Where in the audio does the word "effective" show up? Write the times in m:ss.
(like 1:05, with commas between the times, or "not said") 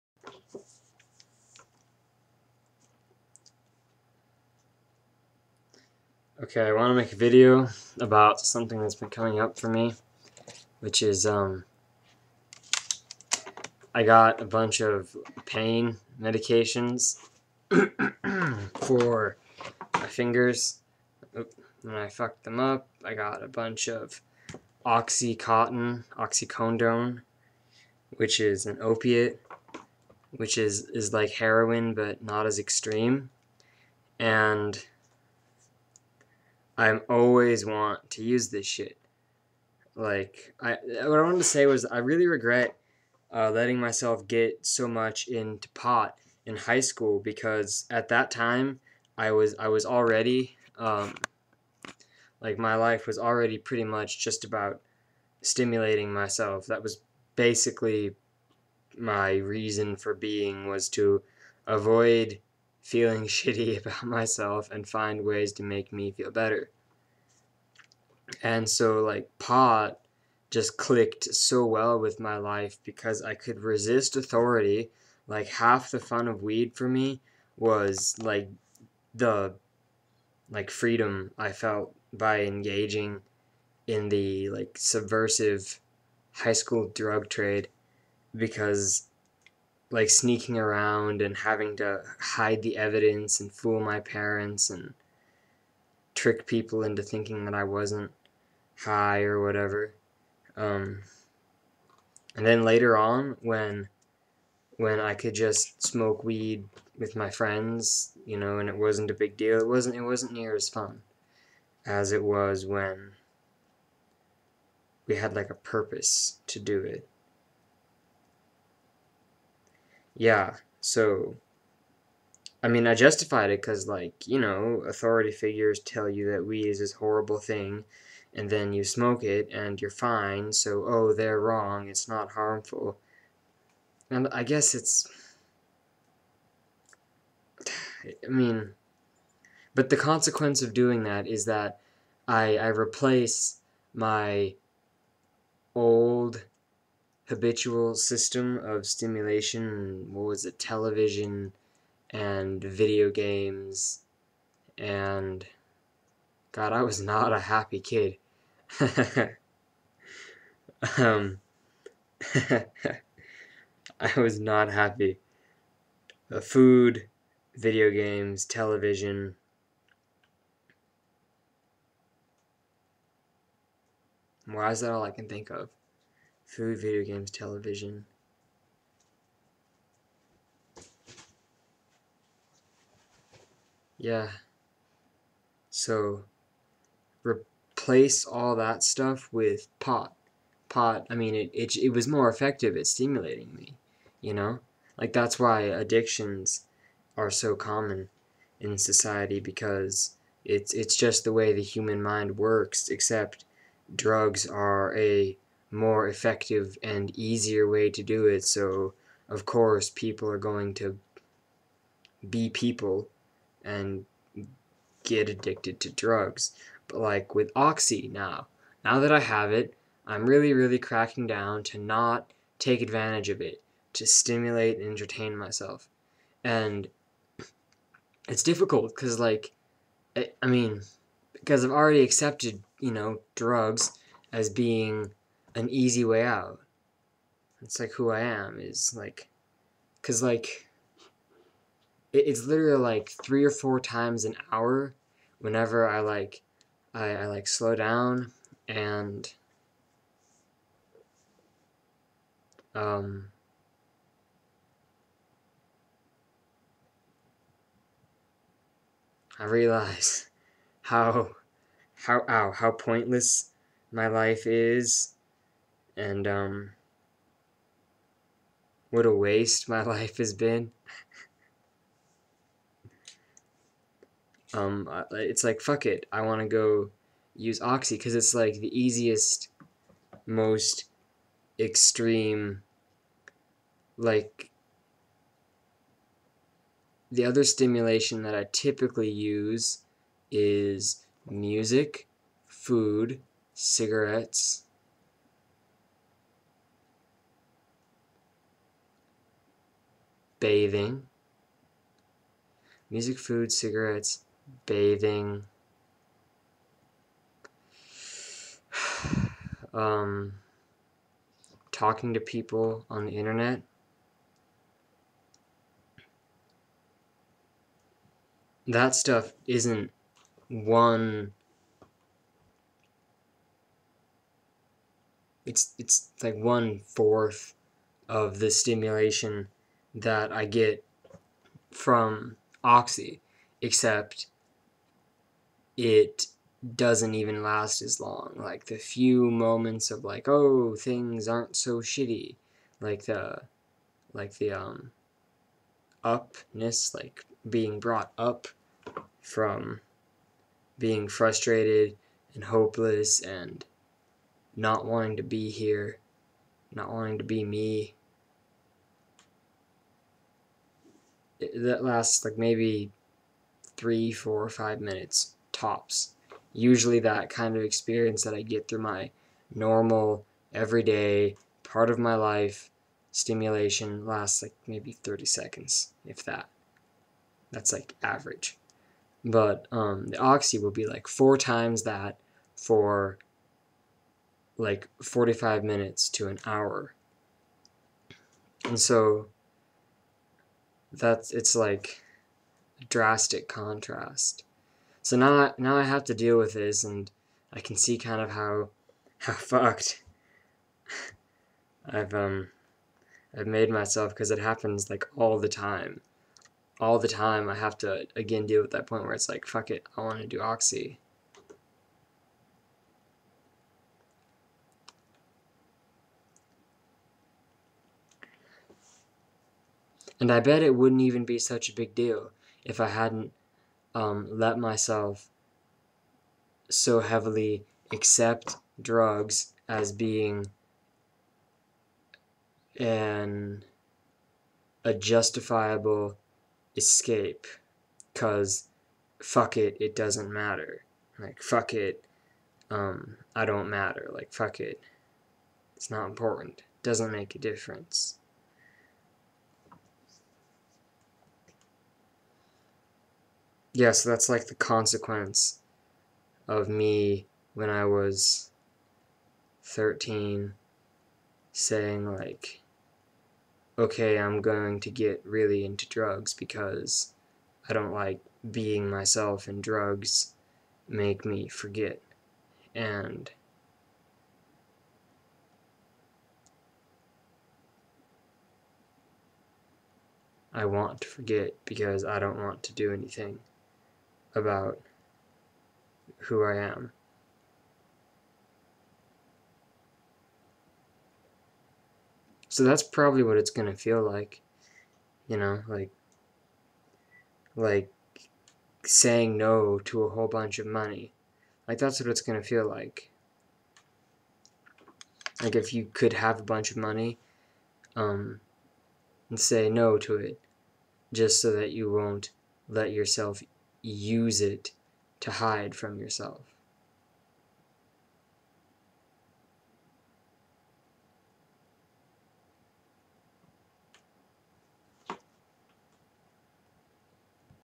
3:12, 3:26.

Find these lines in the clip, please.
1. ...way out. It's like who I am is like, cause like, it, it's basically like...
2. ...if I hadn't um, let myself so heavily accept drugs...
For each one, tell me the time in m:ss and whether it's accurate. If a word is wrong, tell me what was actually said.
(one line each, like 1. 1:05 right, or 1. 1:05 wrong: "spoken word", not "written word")
1. 3:56 wrong: "literally", not "basically"
2. 7:02 right.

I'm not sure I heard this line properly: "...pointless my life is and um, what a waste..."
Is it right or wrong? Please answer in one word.
right.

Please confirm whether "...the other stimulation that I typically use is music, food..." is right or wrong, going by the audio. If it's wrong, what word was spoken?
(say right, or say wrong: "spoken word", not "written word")
right.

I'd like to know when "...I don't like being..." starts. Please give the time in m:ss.
7:47.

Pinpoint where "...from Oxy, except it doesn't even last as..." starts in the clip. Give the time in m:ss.
5:31.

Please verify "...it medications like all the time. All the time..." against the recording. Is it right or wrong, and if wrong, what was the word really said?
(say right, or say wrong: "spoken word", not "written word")
wrong: "happens", not "medications".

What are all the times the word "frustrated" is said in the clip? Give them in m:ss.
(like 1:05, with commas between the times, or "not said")
5:51.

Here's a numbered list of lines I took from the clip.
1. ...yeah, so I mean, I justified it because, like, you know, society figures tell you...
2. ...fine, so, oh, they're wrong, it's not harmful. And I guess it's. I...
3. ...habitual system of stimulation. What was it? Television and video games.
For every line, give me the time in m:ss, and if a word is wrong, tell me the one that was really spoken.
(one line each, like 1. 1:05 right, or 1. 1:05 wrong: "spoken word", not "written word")
1. 2:00 wrong: "authority", not "society"
2. 2:09 right
3. 2:27 right.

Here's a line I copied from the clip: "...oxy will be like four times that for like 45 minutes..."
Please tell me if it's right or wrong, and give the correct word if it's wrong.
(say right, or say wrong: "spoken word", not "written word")
right.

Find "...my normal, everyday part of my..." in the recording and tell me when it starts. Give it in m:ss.
6:08.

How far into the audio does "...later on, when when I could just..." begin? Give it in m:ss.
1:42.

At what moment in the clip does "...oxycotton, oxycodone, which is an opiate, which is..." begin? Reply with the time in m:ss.
0:24.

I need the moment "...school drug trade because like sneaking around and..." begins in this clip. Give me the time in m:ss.
1:26.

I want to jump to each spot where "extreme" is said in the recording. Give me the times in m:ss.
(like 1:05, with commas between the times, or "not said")
0:32, 4:41.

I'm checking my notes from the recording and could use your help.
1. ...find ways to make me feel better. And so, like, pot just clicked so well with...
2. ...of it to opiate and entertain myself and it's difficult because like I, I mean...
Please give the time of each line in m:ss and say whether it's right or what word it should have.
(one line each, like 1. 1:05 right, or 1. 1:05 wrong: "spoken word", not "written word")
1. 1:04 right
2. 3:43 wrong: "stimulate", not "opiate".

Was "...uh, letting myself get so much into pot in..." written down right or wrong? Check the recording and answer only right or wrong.
right.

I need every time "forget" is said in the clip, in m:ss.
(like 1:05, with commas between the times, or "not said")
7:51, 8:01.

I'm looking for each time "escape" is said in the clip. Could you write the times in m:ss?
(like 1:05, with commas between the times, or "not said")
7:16.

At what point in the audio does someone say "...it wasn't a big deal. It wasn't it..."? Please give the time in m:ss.
1:48.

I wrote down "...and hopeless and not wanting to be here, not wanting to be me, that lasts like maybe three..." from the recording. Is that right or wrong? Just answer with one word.
right.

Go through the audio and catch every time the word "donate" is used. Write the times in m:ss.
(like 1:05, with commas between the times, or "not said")
not said.